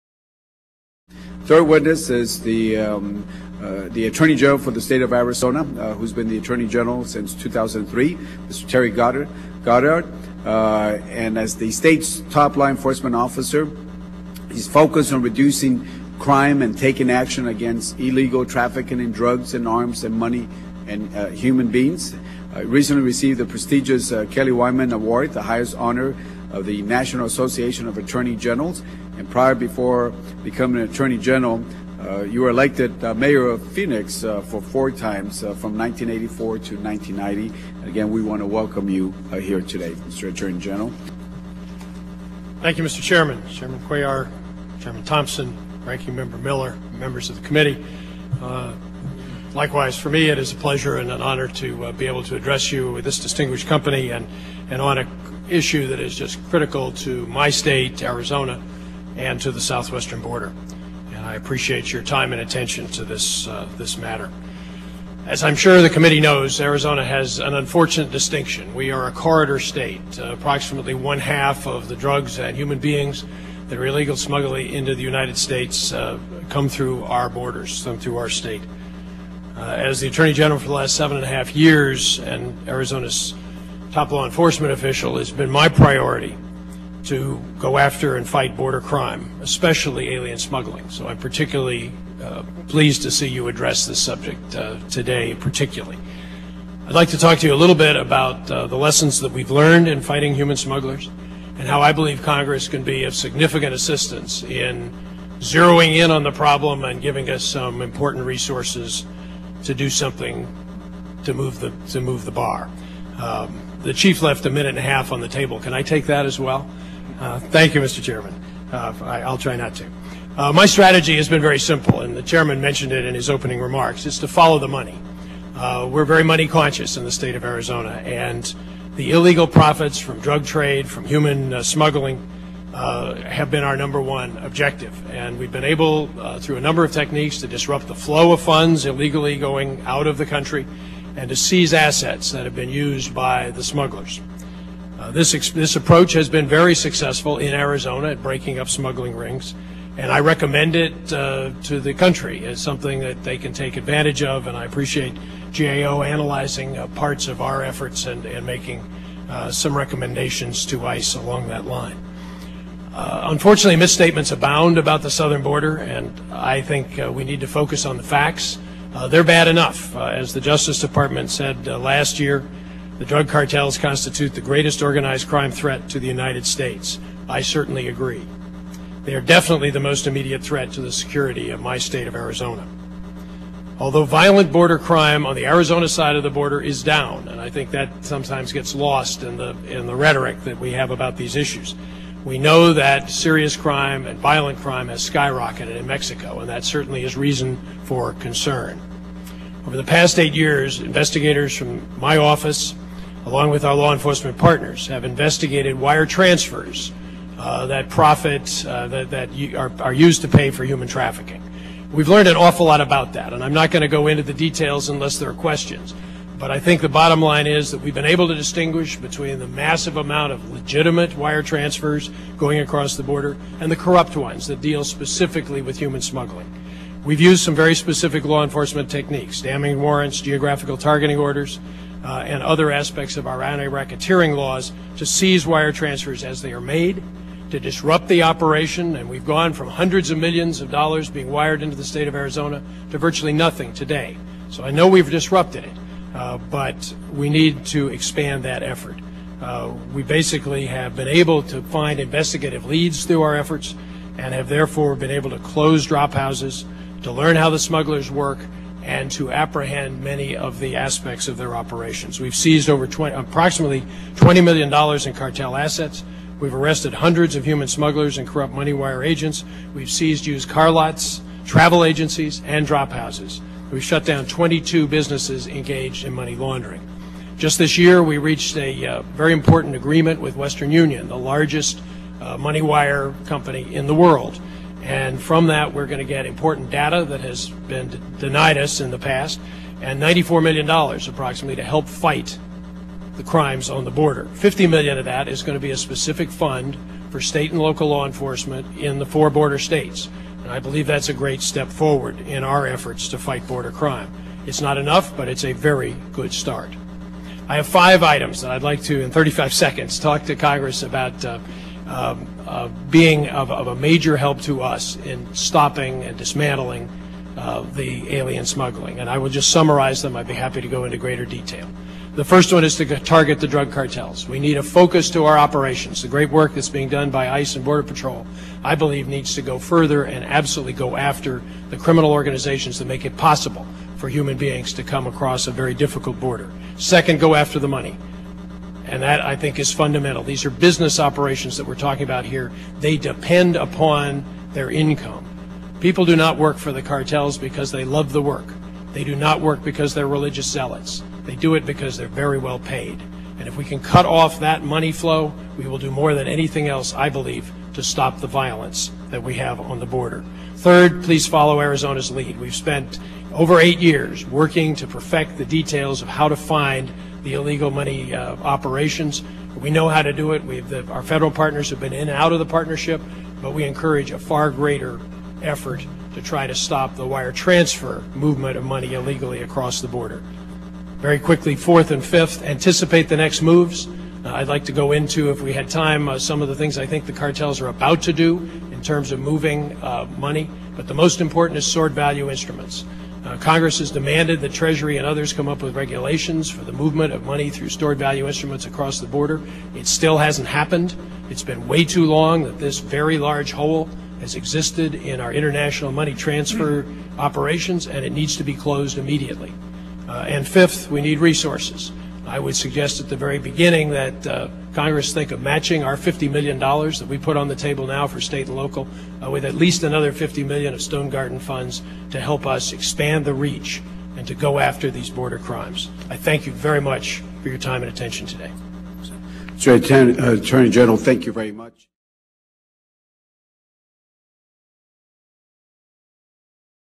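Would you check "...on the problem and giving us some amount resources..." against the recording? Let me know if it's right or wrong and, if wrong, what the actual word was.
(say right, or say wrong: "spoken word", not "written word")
wrong: "important", not "amount".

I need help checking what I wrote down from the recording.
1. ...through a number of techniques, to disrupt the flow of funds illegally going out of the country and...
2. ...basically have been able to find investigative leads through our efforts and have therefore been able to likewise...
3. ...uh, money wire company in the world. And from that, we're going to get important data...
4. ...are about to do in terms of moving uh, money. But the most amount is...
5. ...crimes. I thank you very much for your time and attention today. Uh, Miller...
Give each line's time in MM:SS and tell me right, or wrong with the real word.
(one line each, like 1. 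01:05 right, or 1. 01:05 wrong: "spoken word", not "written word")
1. 02:16 right
2. 04:10 wrong: "close", not "likewise"
3. 04:42 right
4. 06:27 wrong: "important", not "amount"
5. 07:05 wrong: "Attorney", not "Miller".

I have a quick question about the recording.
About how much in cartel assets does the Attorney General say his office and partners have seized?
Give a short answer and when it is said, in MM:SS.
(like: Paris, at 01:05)
$20 million, at 04:24.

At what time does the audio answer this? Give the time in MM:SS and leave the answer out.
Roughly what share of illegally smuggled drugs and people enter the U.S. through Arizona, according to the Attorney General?
01:10.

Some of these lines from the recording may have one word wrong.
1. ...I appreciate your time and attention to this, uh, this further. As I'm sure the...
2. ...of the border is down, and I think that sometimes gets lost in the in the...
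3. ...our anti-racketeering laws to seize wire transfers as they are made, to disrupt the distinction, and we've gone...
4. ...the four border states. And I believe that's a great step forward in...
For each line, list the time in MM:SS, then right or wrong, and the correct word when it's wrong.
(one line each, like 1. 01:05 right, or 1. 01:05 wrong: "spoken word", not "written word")
1. 01:01 wrong: "matter", not "further"
2. 03:06 right
3. 03:53 wrong: "operation", not "distinction"
4. 04:58 right.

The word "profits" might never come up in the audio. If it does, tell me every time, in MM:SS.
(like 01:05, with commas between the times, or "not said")
02:09, 03:27.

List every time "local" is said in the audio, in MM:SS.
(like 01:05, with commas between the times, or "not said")
04:57, 06:58.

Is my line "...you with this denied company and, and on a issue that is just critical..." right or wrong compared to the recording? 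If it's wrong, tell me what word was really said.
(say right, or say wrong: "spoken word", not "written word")
wrong: "distinguished", not "denied".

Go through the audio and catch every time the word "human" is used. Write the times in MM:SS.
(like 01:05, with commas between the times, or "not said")
00:21, 01:12, 01:40, 02:11, 03:30, 03:45, 04:27, 05:34.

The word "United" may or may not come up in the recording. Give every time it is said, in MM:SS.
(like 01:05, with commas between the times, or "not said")
01:15, 02:56.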